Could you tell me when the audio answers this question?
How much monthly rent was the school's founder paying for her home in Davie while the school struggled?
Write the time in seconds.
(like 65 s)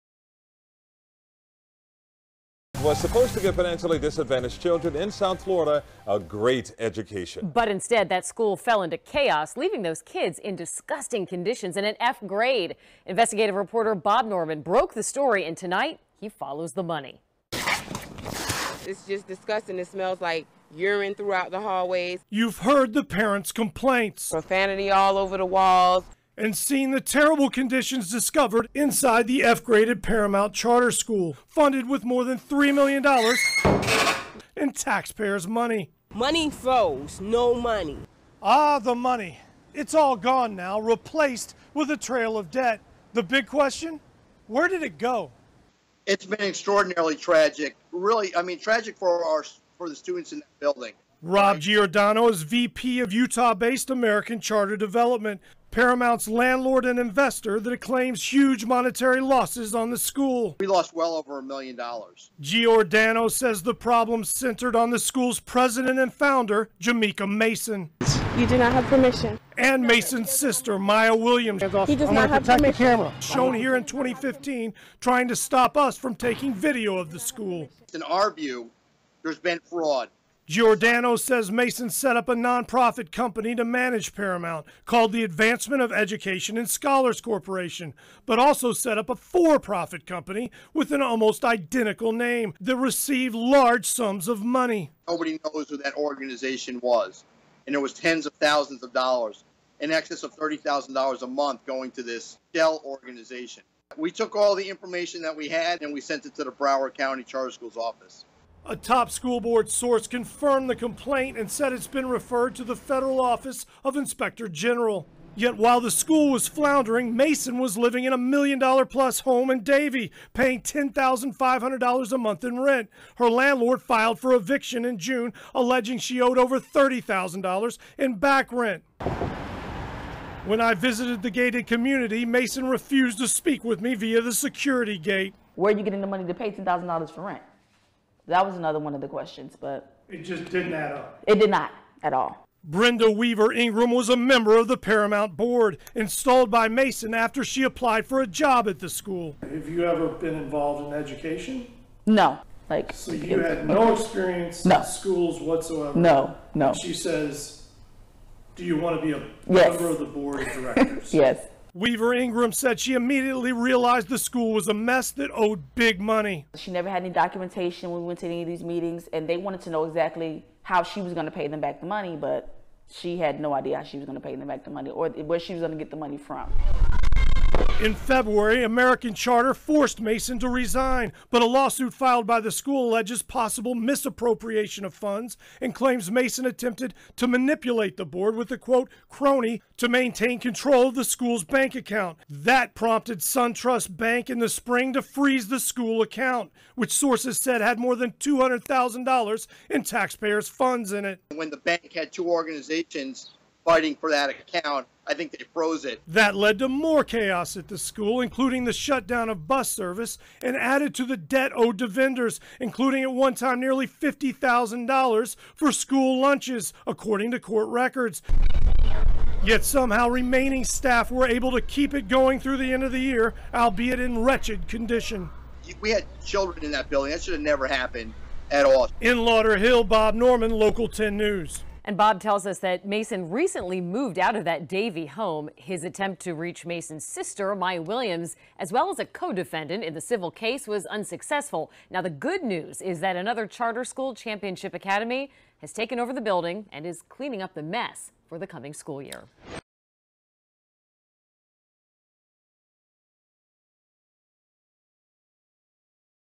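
120 s.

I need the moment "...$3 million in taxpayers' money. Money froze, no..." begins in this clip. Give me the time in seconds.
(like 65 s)
32 s.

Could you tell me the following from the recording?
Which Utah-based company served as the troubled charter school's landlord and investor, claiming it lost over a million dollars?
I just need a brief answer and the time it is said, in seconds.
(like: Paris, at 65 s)
American Charter Development, at 53 s.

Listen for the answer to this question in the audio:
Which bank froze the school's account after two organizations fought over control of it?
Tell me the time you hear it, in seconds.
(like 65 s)
193 s.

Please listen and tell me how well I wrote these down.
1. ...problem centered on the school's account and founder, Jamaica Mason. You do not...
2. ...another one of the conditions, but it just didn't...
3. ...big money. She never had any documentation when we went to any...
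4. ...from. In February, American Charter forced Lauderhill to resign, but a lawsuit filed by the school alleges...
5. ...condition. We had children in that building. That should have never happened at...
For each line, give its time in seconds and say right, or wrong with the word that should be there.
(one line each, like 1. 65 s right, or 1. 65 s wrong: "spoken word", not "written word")
1. 63 s wrong: "president", not "account"
2. 138 s wrong: "questions", not "conditions"
3. 165 s right
4. 176 s wrong: "Mason", not "Lauderhill"
5. 224 s right.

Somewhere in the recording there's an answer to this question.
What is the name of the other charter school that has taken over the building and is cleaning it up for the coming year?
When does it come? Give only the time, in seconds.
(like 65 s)
244 s.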